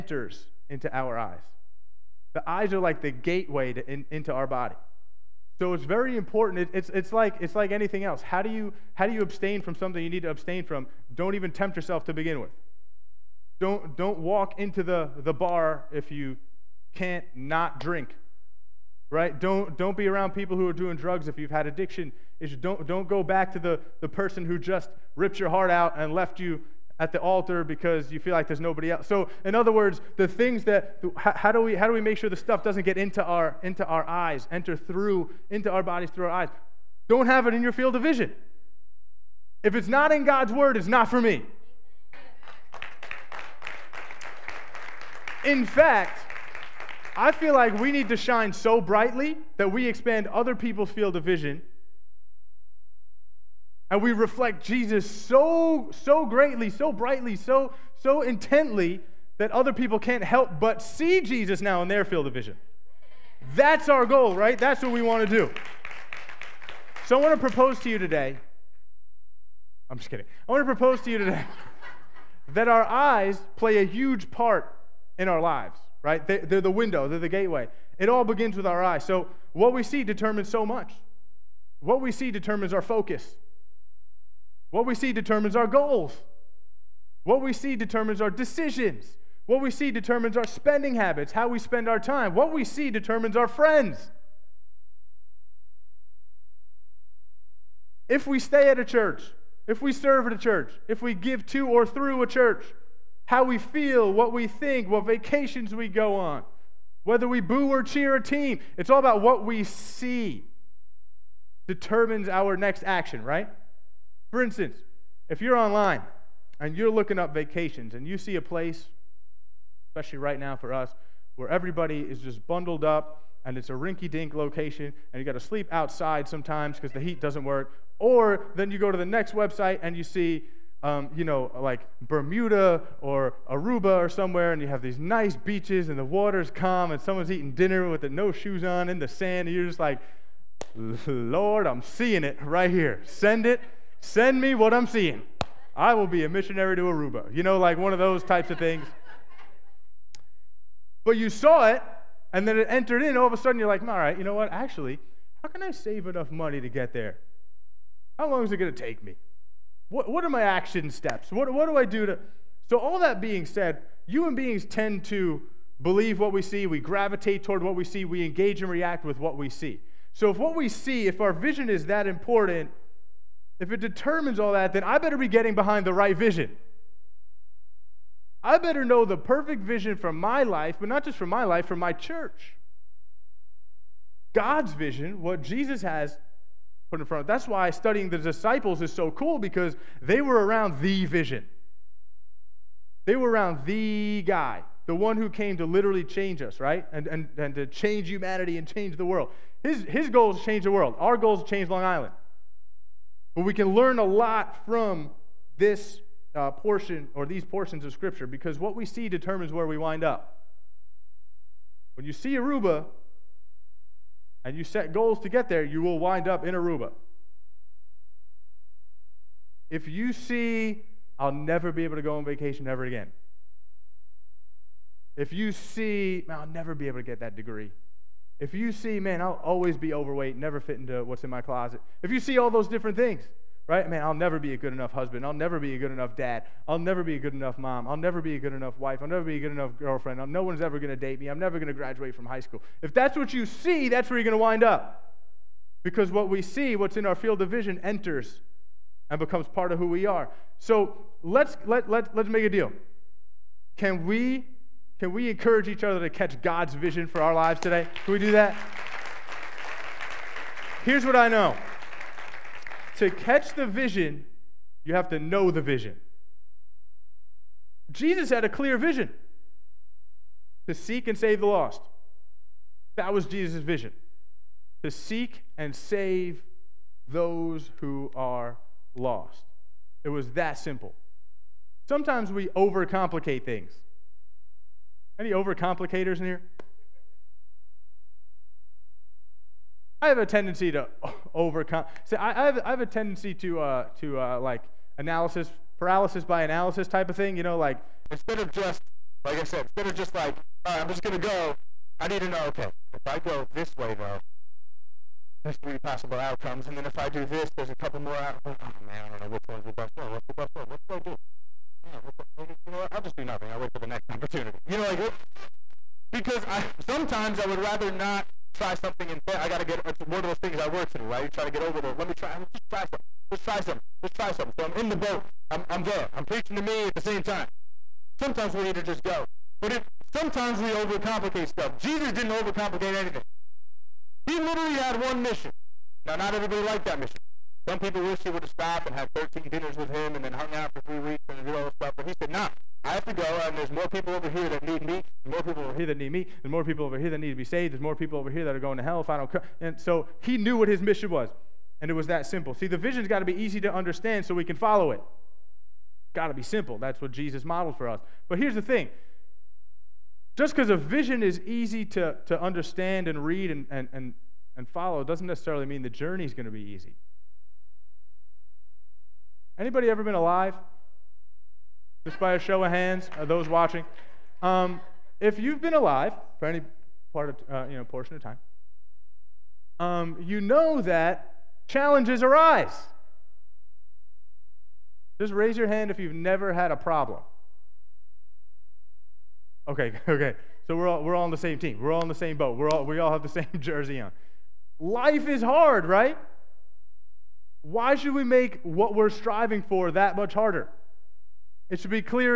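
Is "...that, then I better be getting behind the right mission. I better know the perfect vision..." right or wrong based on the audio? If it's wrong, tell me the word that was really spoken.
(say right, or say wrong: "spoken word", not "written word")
wrong: "vision", not "mission".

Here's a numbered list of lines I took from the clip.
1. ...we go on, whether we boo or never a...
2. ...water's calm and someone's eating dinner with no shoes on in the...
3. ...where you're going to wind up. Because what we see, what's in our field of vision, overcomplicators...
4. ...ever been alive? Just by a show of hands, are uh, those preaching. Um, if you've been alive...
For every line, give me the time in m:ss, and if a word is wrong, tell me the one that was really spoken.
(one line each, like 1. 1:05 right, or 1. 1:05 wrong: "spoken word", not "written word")
1. 1:45 wrong: "cheer", not "never"
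2. 2:16 right
3. 4:04 wrong: "enters", not "overcomplicators"
4. 6:09 wrong: "watching", not "preaching".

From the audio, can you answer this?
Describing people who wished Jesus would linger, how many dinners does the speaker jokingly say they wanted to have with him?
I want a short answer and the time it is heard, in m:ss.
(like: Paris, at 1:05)
13, at 5:39.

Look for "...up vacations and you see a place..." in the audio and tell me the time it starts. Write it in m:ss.
1:57.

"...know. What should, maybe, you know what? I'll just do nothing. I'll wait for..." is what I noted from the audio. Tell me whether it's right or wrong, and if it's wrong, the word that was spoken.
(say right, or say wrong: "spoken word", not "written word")
right.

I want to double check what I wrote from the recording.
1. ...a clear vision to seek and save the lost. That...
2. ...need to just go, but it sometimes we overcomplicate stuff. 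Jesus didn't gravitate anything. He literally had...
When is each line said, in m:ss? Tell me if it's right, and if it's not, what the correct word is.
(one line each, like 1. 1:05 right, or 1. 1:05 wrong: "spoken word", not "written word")
1. 4:28 right
2. 5:28 wrong: "overcomplicate", not "gravitate".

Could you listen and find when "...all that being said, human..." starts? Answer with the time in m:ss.
2:42.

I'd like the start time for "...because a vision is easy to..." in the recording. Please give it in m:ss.
6:00.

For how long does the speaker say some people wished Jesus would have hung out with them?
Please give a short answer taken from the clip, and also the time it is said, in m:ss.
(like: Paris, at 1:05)
three weeks, at 5:40.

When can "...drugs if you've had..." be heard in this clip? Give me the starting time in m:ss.
0:20.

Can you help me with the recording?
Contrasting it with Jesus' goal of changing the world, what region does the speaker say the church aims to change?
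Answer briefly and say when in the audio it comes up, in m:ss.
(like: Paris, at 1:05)
Long Island, at 3:20.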